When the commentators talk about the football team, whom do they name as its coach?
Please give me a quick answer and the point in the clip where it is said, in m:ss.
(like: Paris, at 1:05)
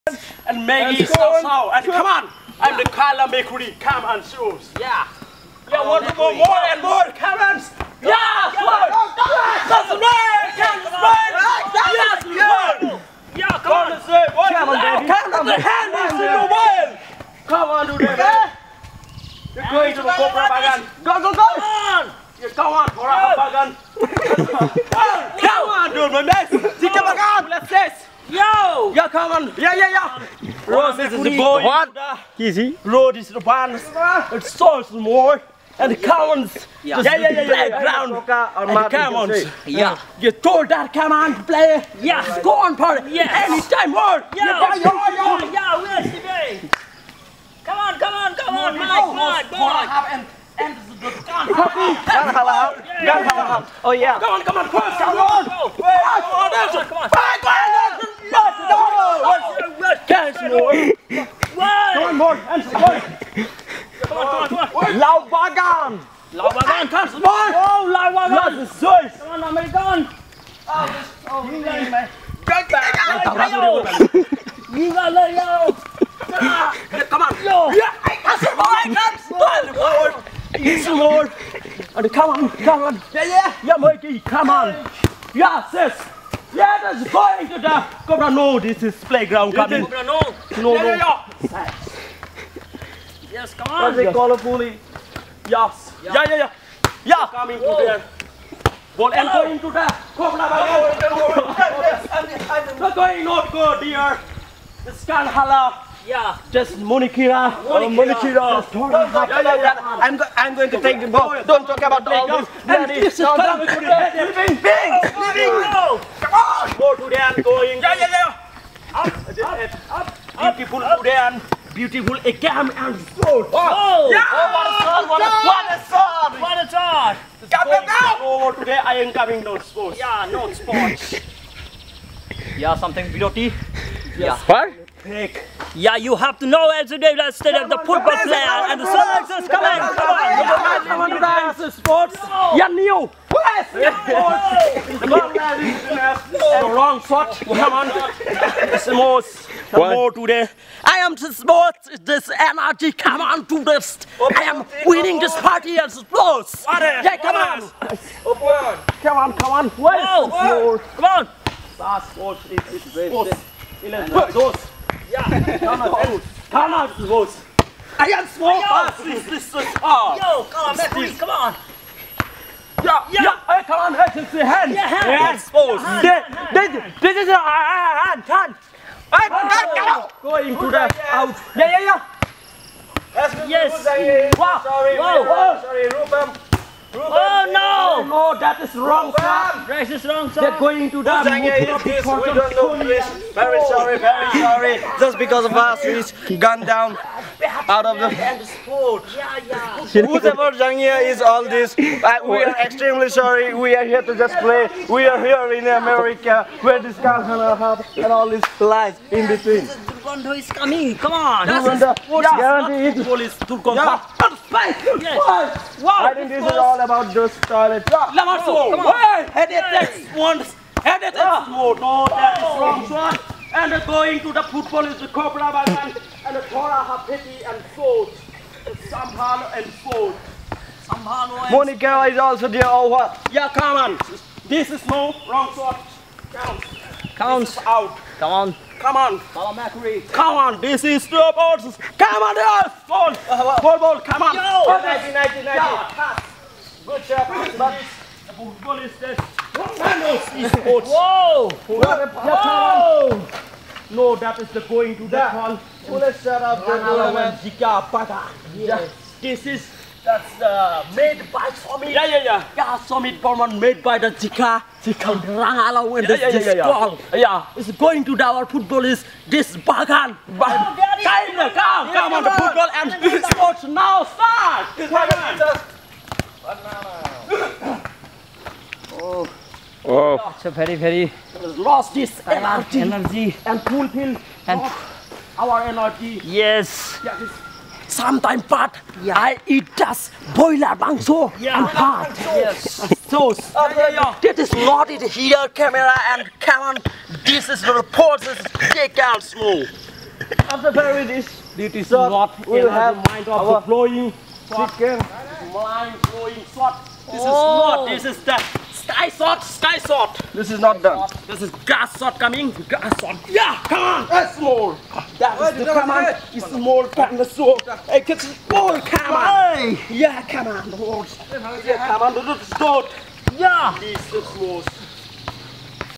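Thanos, at 4:09.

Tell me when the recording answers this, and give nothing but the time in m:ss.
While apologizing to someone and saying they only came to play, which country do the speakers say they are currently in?
3:25.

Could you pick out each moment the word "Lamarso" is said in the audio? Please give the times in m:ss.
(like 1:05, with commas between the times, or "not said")
3:38.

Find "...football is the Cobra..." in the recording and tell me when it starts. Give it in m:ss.
3:44.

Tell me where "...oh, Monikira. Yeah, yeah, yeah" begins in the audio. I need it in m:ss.
1:47.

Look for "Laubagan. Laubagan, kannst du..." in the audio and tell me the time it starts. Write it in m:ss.
1:05.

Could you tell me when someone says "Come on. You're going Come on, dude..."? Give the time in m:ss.
0:21.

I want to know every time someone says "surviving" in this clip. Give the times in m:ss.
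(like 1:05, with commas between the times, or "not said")
not said.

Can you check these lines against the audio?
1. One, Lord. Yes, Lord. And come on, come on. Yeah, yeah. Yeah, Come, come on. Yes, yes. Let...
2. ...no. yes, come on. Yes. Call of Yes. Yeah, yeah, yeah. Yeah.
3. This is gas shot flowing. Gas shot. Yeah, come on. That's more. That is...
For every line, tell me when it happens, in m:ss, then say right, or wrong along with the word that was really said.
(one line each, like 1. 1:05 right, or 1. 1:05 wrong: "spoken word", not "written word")
1. 1:19 wrong: "Mikey", not "Come"
2. 1:30 right
3. 5:11 wrong: "coming", not "flowing".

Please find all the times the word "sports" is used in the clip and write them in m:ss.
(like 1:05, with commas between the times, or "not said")
2:31, 2:35, 2:42, 3:18, 4:33.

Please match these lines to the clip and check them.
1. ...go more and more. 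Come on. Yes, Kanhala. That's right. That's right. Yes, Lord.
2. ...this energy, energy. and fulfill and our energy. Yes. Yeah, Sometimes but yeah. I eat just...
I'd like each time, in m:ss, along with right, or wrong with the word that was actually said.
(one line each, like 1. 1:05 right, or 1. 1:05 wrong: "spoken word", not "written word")
1. 0:06 wrong: "Lord", not "Kanhala"
2. 4:41 right.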